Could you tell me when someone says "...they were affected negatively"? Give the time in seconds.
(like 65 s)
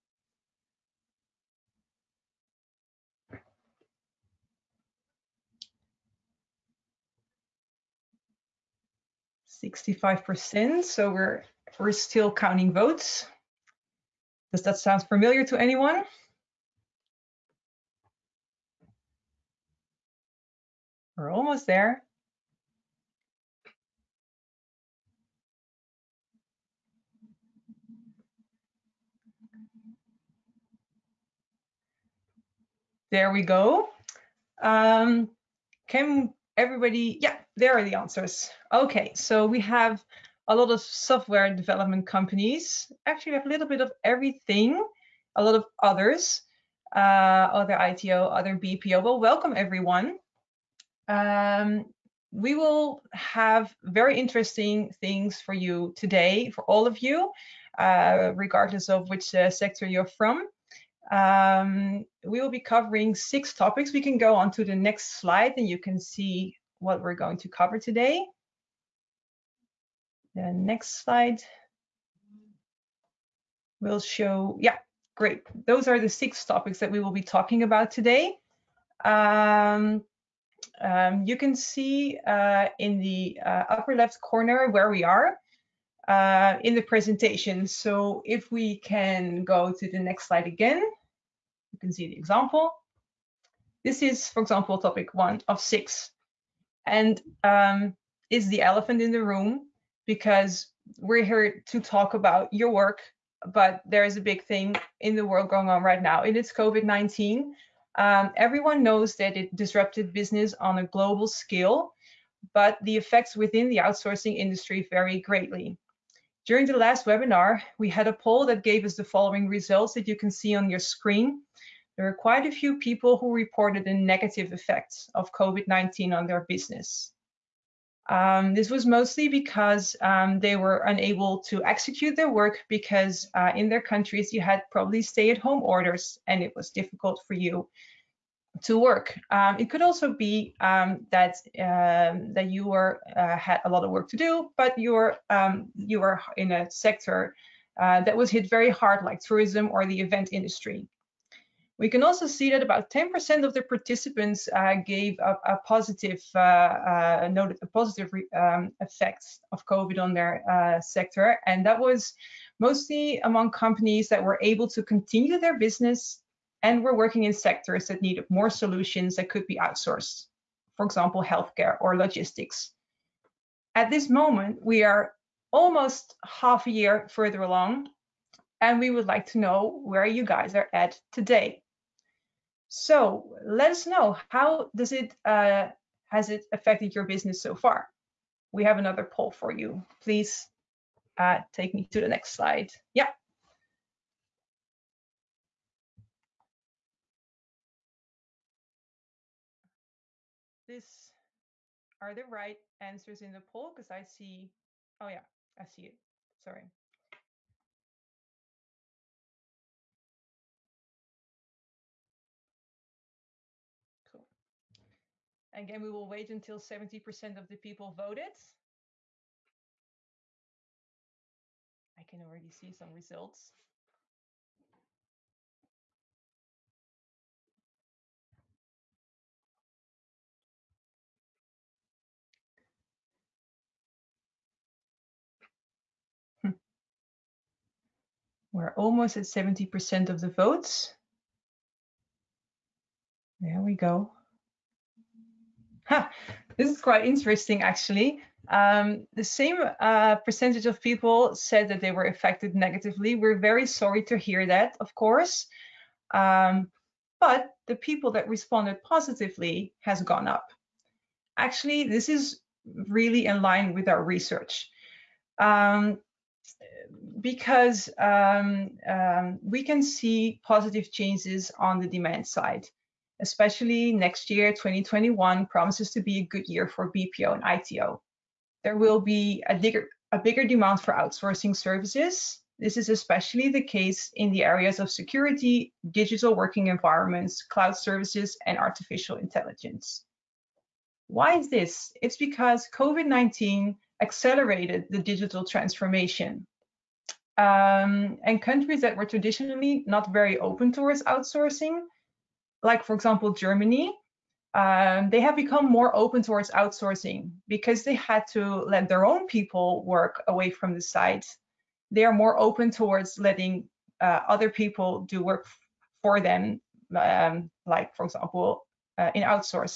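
251 s.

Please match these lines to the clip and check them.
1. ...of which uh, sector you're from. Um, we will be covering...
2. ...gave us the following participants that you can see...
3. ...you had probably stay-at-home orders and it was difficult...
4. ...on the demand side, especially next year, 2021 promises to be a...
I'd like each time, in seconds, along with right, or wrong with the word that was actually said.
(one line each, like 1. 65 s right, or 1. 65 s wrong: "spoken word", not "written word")
1. 58 s right
2. 118 s wrong: "results", not "participants"
3. 134 s right
4. 271 s right.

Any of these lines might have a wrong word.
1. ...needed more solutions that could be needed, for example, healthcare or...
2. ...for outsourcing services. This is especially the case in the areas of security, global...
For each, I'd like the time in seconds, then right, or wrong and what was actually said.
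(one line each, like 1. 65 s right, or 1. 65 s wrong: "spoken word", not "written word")
1. 168 s wrong: "outsourced", not "needed"
2. 280 s wrong: "digital", not "global".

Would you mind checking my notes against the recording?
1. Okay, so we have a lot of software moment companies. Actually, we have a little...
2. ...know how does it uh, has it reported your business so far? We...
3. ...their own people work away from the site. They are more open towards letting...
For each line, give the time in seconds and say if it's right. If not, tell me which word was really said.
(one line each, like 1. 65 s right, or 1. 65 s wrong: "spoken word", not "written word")
1. 38 s wrong: "development", not "moment"
2. 183 s wrong: "affected", not "reported"
3. 308 s right.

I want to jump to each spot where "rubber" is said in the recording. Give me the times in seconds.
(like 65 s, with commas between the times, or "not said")
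not said.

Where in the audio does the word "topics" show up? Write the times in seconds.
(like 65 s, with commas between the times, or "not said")
63 s, 76 s, 94 s.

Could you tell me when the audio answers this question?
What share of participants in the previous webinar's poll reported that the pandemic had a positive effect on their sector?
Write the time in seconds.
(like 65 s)
152 s.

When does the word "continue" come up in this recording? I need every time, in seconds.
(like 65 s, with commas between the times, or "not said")
164 s.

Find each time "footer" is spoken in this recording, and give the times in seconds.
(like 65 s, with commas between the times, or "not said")
not said.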